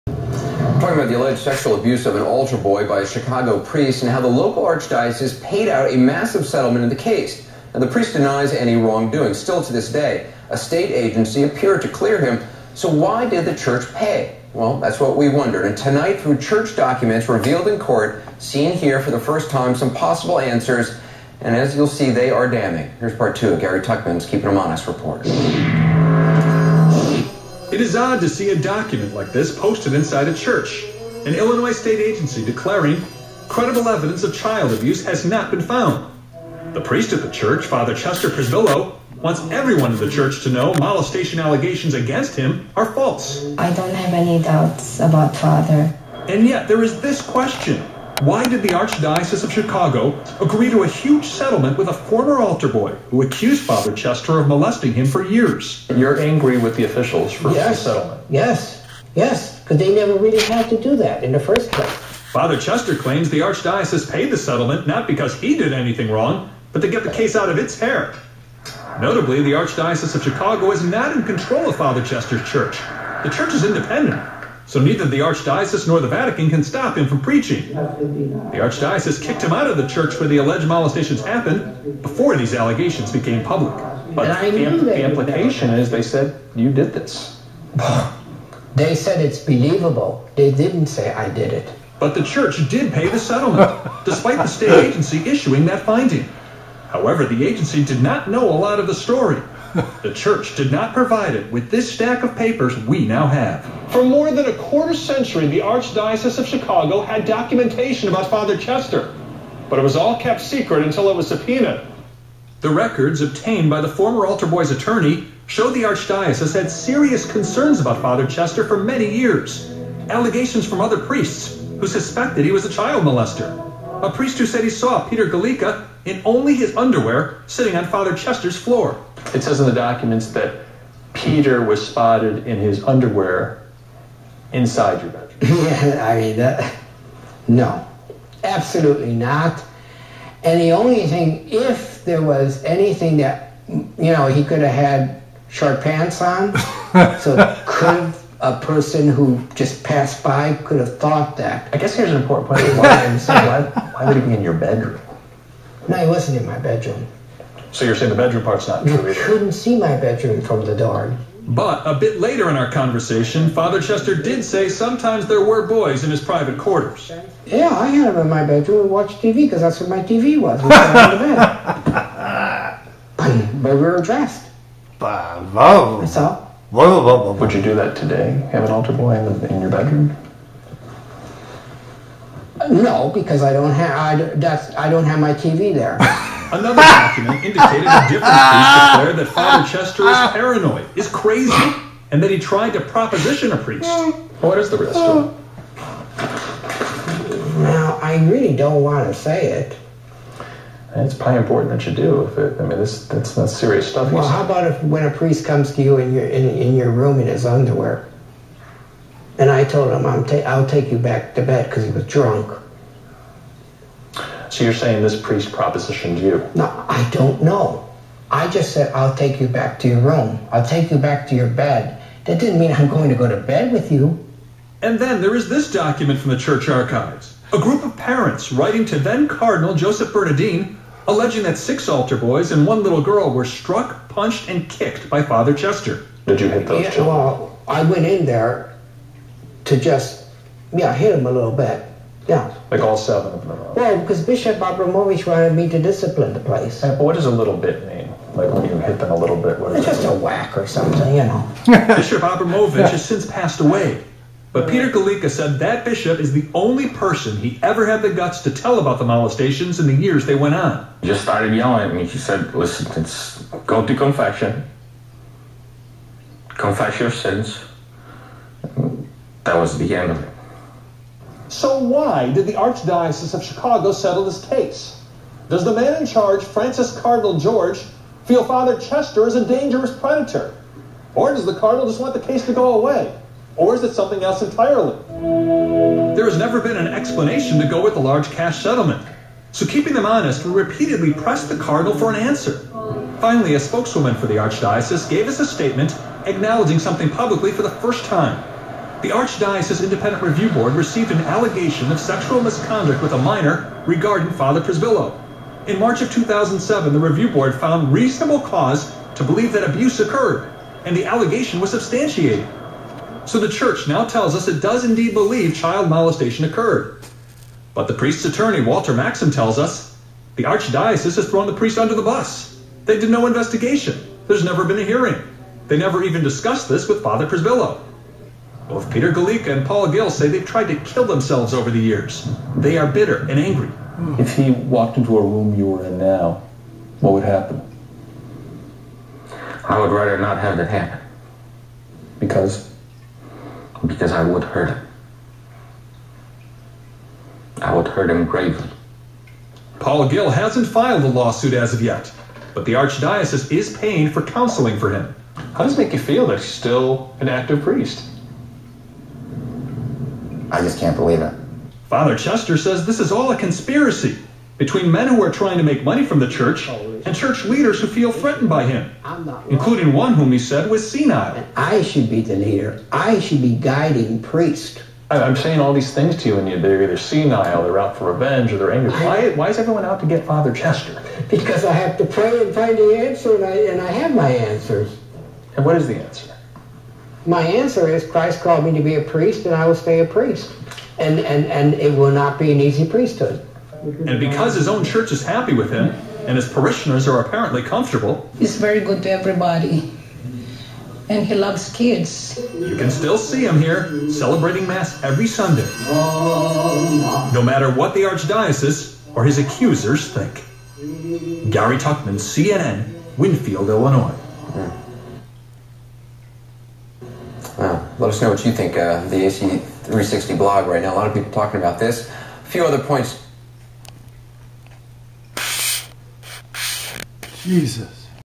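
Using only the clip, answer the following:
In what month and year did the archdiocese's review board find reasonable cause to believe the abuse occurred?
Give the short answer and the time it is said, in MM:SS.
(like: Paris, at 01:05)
March 2007, at 05:05.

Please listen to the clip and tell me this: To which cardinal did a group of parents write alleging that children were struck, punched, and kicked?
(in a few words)
Joseph Bernardin.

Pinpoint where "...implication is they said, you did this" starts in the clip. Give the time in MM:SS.
01:25.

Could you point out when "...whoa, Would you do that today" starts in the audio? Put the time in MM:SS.
02:57.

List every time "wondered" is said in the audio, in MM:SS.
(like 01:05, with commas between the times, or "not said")
00:15.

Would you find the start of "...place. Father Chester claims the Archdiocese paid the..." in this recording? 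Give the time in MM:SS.
01:01.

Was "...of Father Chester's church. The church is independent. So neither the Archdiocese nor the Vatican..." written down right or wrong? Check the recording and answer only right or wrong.
right.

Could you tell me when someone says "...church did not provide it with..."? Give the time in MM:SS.
01:40.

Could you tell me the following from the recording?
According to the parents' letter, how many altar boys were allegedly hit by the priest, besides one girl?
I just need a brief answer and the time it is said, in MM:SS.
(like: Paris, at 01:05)
6, at 03:51.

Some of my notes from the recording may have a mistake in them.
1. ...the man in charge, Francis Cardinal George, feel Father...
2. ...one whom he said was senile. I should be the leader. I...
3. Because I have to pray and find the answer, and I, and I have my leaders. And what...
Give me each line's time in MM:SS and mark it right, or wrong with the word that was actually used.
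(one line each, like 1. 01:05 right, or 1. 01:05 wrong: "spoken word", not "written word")
1. 04:35 right
2. 06:09 right
3. 06:21 wrong: "answers", not "leaders".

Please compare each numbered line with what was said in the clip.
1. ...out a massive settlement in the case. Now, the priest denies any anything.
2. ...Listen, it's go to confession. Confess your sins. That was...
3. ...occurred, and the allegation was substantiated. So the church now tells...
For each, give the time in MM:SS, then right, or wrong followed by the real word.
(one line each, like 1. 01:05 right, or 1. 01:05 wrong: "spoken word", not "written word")
1. 00:05 wrong: "wrongdoing", not "anything"
2. 04:22 right
3. 05:09 right.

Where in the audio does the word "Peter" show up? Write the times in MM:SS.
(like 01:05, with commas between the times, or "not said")
02:05, 02:11, 04:14, 05:28.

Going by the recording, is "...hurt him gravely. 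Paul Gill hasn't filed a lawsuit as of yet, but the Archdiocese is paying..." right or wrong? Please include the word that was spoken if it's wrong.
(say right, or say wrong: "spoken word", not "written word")
right.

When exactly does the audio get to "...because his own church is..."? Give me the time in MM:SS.
06:34.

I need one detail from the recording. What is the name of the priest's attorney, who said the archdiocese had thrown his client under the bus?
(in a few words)
Walter Maxim.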